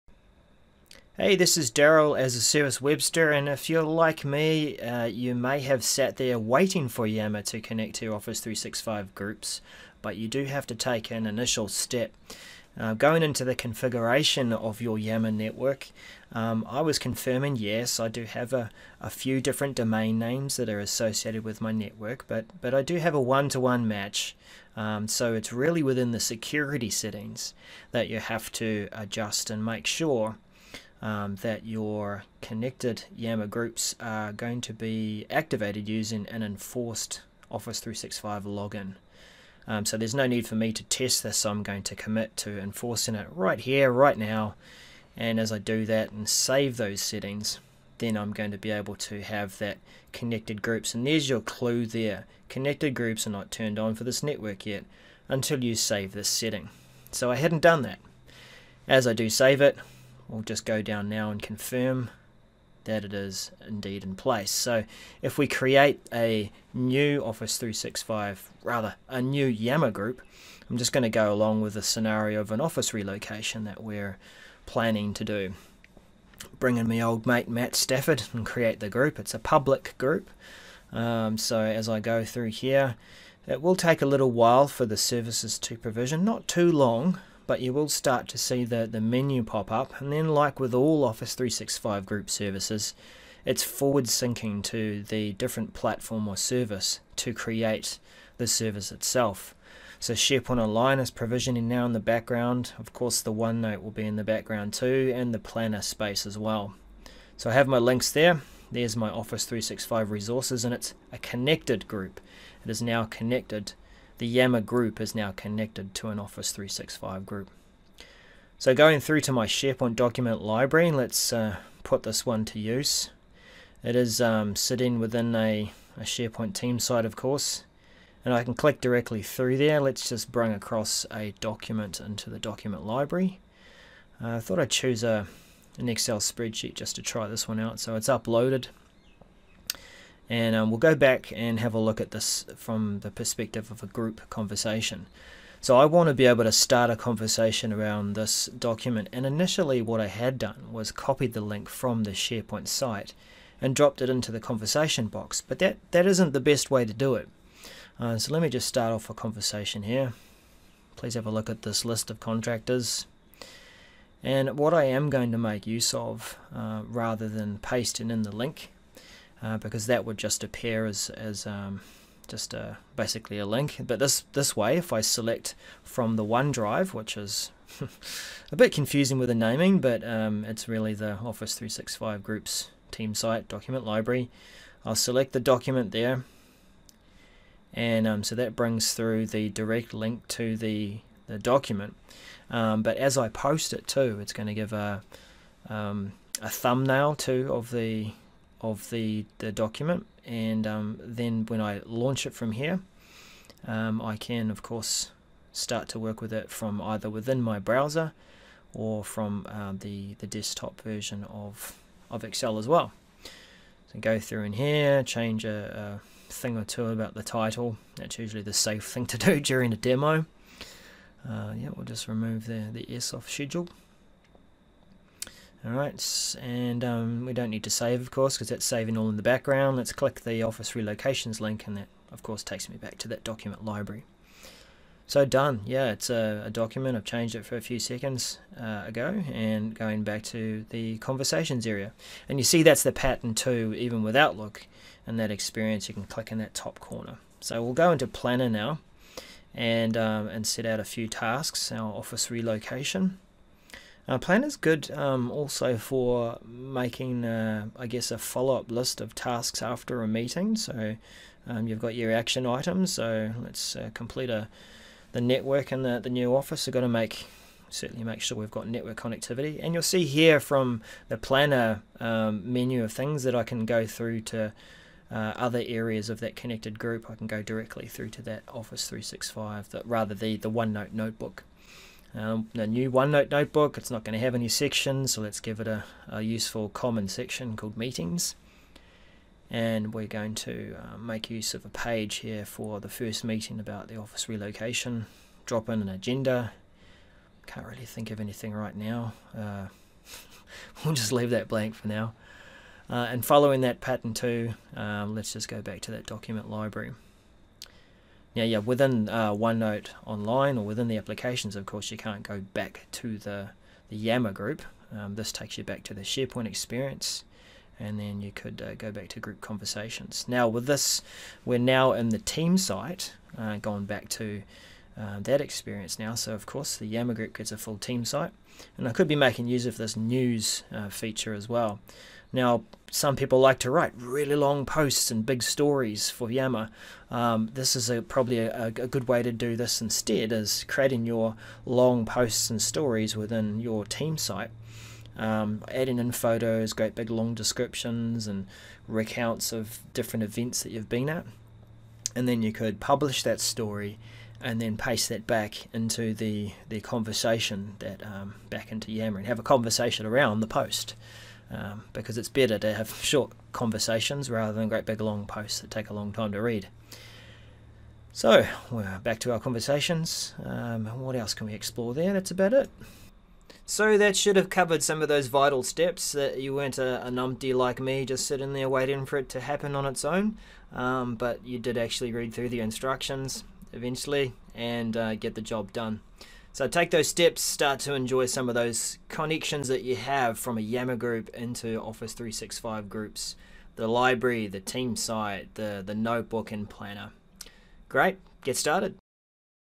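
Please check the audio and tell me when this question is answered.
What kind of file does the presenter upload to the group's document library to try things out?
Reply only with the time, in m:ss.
2:15.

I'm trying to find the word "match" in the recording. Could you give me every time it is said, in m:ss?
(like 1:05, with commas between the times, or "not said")
0:23.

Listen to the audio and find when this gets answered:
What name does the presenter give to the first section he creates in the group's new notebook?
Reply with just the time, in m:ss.
4:47.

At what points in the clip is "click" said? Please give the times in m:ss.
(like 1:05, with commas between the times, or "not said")
2:08, 3:49, 4:06.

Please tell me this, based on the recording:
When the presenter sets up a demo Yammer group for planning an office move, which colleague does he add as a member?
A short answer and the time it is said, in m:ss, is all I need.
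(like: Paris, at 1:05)
Matt Stafford, at 1:17.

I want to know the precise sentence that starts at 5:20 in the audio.
Now, with this, we're now in the team site, uh, going back to uh, that experience now.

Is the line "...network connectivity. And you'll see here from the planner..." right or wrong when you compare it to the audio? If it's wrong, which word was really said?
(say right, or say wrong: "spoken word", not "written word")
right.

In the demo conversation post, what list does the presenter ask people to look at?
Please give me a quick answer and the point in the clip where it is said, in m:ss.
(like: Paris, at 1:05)
list of contractors, at 2:41.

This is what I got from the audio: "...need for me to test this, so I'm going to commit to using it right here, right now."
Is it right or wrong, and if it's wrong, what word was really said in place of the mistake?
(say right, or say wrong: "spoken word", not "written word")
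wrong: "enforcing", not "using".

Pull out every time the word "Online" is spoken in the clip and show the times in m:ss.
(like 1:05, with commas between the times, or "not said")
1:40, 5:10.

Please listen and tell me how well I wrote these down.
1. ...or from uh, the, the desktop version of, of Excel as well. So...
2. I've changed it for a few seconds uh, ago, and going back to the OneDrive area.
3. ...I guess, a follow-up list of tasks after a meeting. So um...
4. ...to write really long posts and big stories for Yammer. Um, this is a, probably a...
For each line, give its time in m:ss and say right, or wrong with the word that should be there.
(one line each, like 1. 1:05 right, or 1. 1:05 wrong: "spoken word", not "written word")
1. 3:28 right
2. 3:56 wrong: "Conversations", not "OneDrive"
3. 4:17 right
4. 5:33 right.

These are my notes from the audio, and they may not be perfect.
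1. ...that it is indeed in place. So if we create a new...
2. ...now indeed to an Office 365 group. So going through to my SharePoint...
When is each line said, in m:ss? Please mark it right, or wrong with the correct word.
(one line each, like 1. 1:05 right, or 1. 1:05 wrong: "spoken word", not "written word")
1. 1:02 right
2. 1:55 wrong: "connected", not "indeed".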